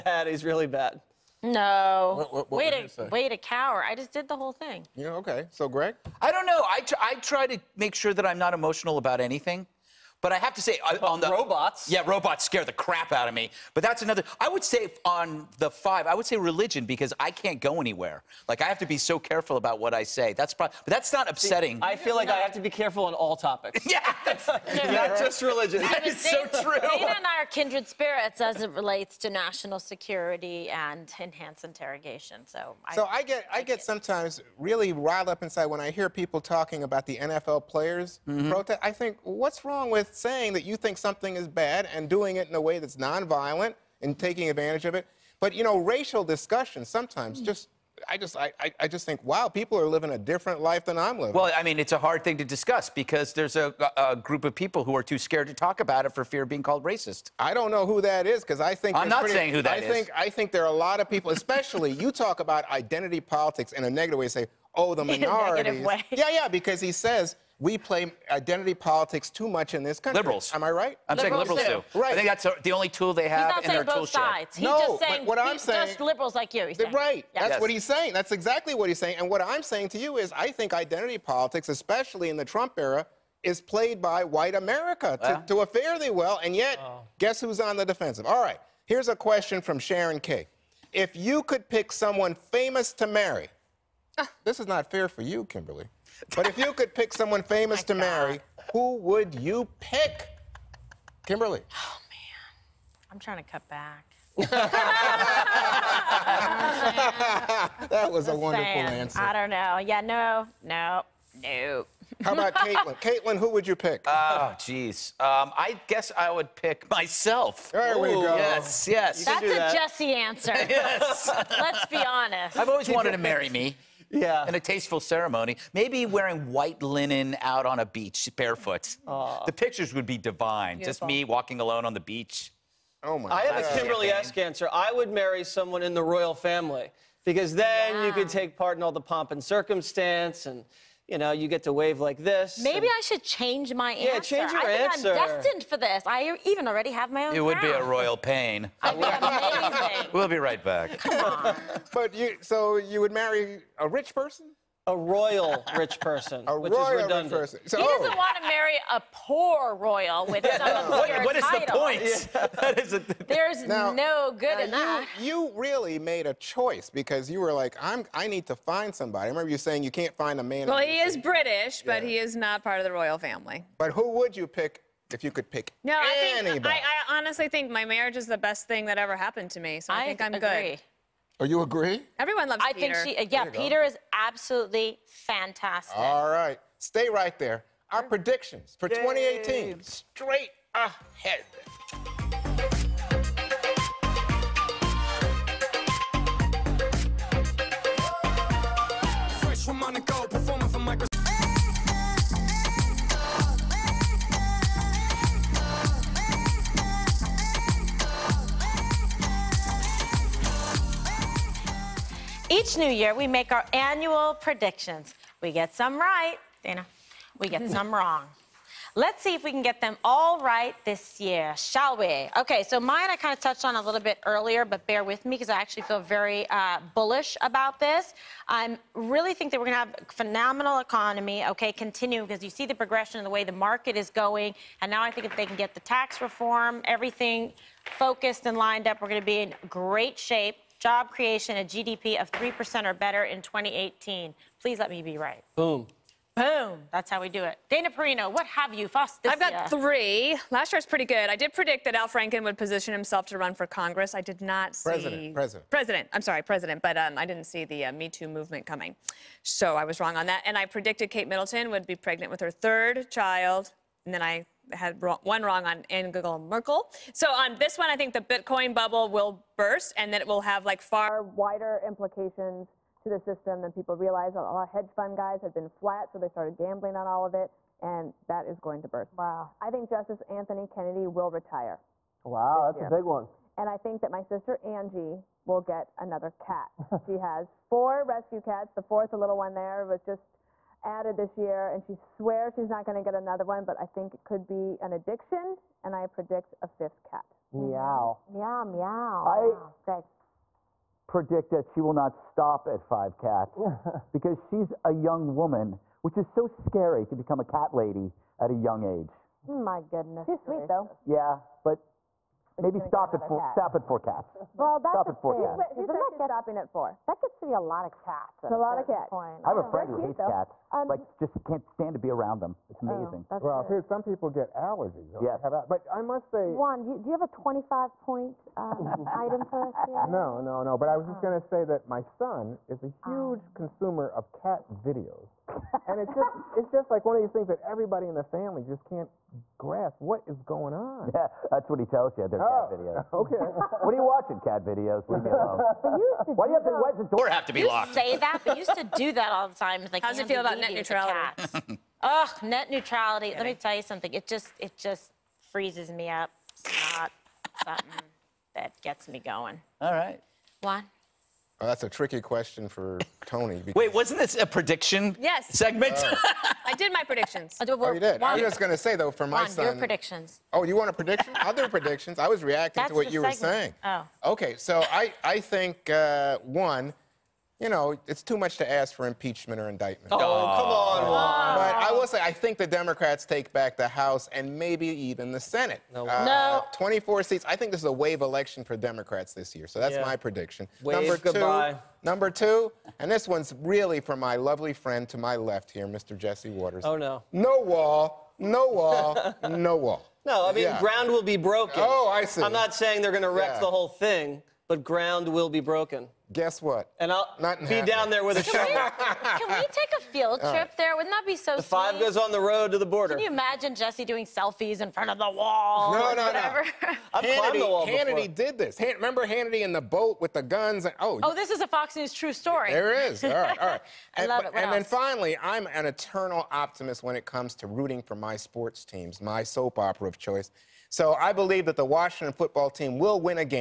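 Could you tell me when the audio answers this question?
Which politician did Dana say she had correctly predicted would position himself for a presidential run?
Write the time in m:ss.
4:11.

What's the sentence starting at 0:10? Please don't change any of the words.
But I have to say, well, uh, on the robots.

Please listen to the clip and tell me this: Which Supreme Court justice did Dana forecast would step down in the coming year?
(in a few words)
Anthony Kennedy.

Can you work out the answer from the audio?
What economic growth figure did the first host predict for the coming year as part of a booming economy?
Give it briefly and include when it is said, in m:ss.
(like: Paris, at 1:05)
3%, at 4:01.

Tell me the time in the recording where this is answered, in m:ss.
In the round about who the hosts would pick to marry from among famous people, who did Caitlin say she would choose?
1:55.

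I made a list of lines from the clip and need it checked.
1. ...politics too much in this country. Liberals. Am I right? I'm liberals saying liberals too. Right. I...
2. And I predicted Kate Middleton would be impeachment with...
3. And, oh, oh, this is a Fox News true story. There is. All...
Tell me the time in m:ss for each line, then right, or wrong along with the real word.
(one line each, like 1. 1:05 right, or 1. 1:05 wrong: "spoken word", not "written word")
1. 1:08 right
2. 4:20 wrong: "pregnant", not "impeachment"
3. 7:00 right.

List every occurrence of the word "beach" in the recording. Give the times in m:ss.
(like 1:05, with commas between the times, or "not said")
2:07, 2:11.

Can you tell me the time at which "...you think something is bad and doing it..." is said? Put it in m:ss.
0:40.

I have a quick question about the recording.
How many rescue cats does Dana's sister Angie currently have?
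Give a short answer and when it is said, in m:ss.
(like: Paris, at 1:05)
4, at 4:47.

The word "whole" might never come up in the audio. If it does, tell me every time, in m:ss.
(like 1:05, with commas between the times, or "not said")
0:04, 6:43.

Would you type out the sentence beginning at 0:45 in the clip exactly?
But you know, racial discussion sometimes hmm.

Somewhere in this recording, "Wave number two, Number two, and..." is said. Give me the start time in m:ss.
6:30.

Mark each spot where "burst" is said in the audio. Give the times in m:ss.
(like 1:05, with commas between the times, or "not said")
4:29, 4:38.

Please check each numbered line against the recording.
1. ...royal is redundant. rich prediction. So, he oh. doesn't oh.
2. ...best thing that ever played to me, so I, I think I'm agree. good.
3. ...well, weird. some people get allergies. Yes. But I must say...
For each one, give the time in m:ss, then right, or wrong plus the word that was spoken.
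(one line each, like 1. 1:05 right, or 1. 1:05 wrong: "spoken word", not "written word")
1. 2:36 wrong: "person", not "prediction"
2. 2:58 wrong: "happened", not "played"
3. 5:23 right.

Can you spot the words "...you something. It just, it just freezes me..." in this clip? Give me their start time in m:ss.
5:53.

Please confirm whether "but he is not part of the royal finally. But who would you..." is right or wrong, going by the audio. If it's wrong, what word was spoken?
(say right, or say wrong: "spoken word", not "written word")
wrong: "family", not "finally".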